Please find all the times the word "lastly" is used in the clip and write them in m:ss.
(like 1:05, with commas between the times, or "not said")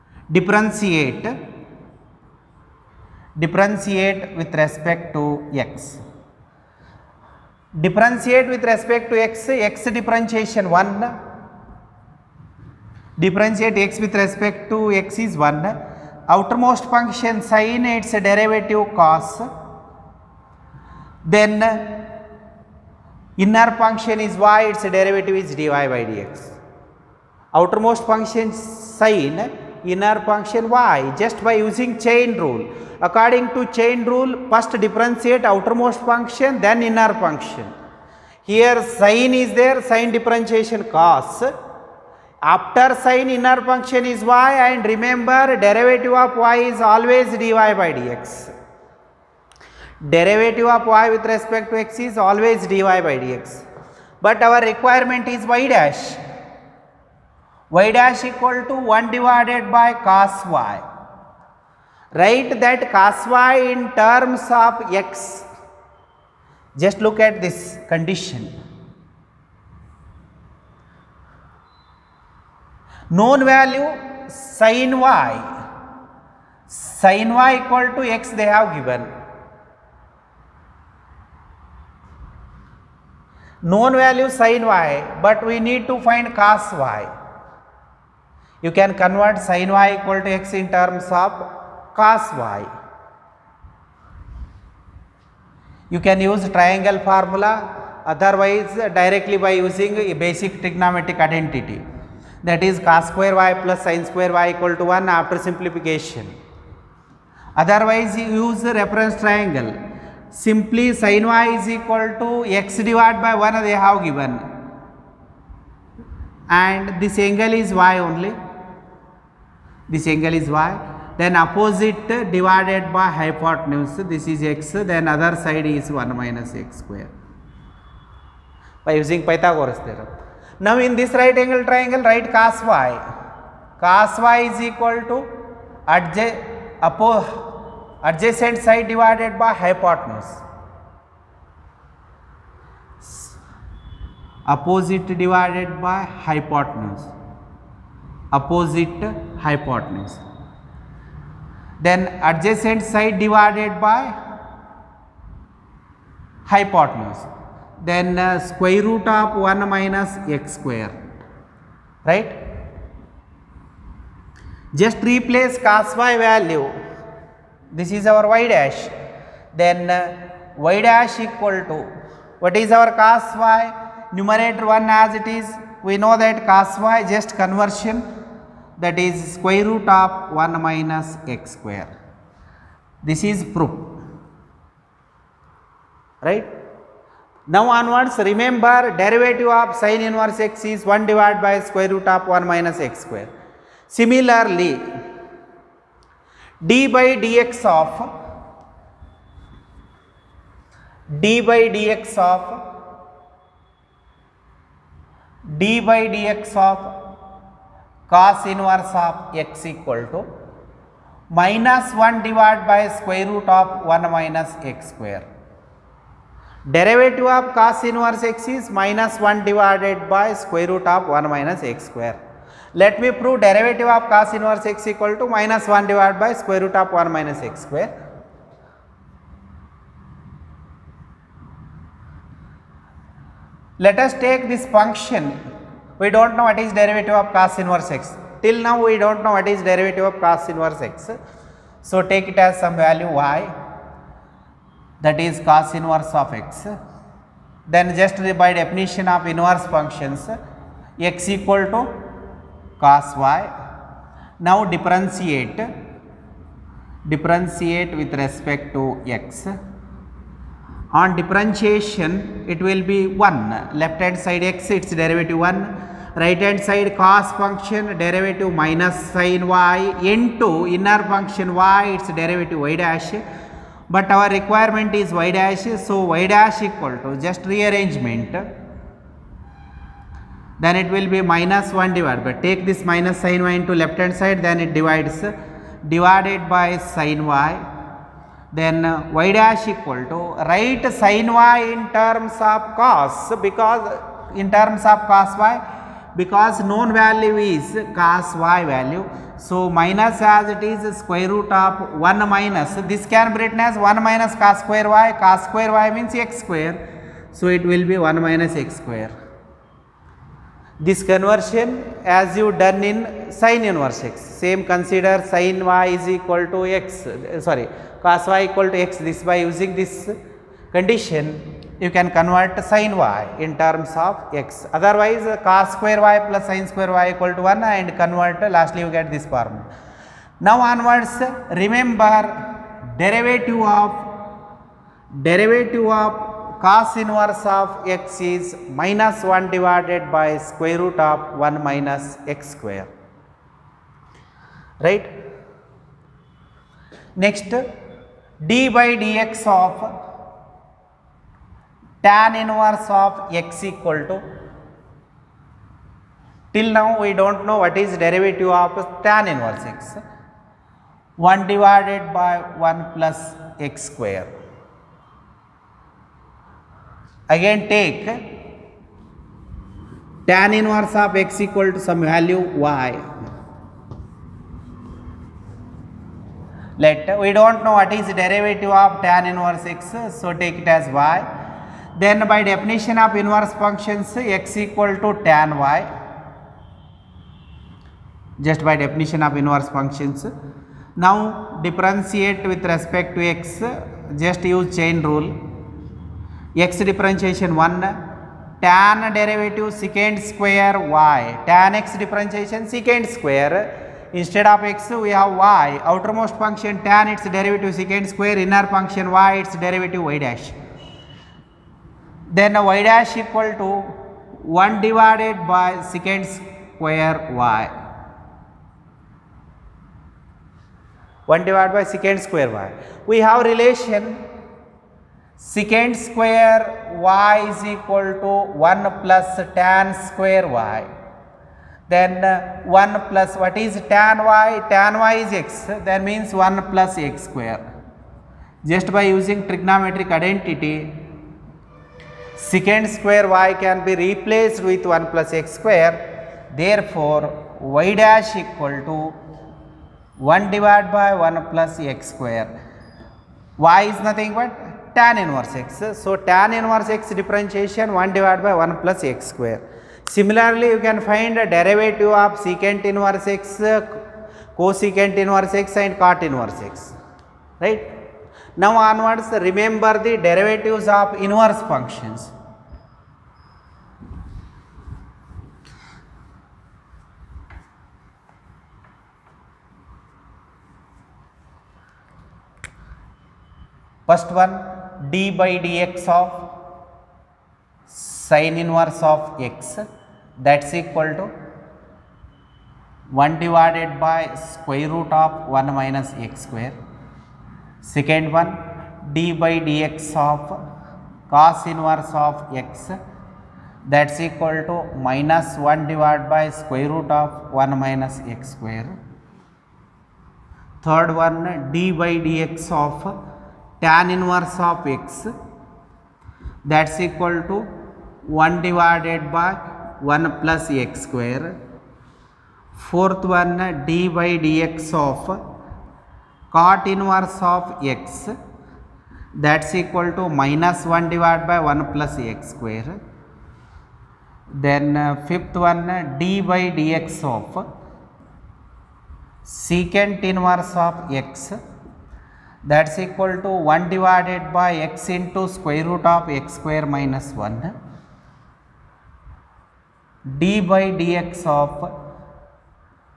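5:28.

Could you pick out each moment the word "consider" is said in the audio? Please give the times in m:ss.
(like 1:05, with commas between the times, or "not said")
5:14.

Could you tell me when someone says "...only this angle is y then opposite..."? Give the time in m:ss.
1:57.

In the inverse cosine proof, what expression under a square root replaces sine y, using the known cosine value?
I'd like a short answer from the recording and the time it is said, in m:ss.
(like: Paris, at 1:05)
1 minus cos square y, at 5:03.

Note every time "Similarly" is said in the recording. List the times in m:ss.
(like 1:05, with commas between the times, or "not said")
3:13, 7:40.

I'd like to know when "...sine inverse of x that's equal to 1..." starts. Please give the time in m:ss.
8:07.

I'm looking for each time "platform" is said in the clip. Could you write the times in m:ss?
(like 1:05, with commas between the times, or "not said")
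not said.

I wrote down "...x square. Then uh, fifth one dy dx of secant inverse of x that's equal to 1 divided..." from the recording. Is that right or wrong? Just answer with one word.
right.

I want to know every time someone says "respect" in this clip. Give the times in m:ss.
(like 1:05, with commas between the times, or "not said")
0:04, 0:08, 0:14, 0:51, 4:18, 6:32.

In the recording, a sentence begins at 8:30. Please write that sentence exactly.
Third one d by dx of tan inverse of x that's equal to 1 divided by 1 plus x square.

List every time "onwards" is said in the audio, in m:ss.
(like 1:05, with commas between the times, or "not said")
3:07, 5:30, 7:48.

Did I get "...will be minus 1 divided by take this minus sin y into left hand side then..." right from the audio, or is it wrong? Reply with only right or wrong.
right.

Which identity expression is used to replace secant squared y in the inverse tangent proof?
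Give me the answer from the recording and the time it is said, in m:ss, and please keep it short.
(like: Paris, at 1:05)
1 plus tan square y, at 7:08.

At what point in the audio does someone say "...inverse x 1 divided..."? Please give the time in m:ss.
5:59.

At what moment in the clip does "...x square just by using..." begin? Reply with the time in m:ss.
7:17.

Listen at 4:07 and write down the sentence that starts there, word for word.
Then just by definition of inverse functions x equal to cos y.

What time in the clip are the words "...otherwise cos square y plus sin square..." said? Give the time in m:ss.
5:24.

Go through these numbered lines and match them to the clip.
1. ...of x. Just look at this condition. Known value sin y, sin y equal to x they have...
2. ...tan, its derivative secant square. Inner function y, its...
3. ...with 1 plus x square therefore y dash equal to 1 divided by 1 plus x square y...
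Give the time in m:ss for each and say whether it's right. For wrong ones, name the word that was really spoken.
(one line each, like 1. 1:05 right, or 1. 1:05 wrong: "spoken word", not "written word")
1. 1:04 right
2. 6:46 right
3. 7:24 right.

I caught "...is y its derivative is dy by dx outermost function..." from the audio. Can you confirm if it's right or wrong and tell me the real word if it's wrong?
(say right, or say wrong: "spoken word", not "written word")
right.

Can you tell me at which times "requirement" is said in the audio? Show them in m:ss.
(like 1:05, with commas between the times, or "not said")
0:54, 4:34.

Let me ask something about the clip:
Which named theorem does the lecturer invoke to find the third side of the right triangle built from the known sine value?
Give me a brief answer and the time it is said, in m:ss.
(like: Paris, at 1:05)
Pythagoras theorem, at 2:09.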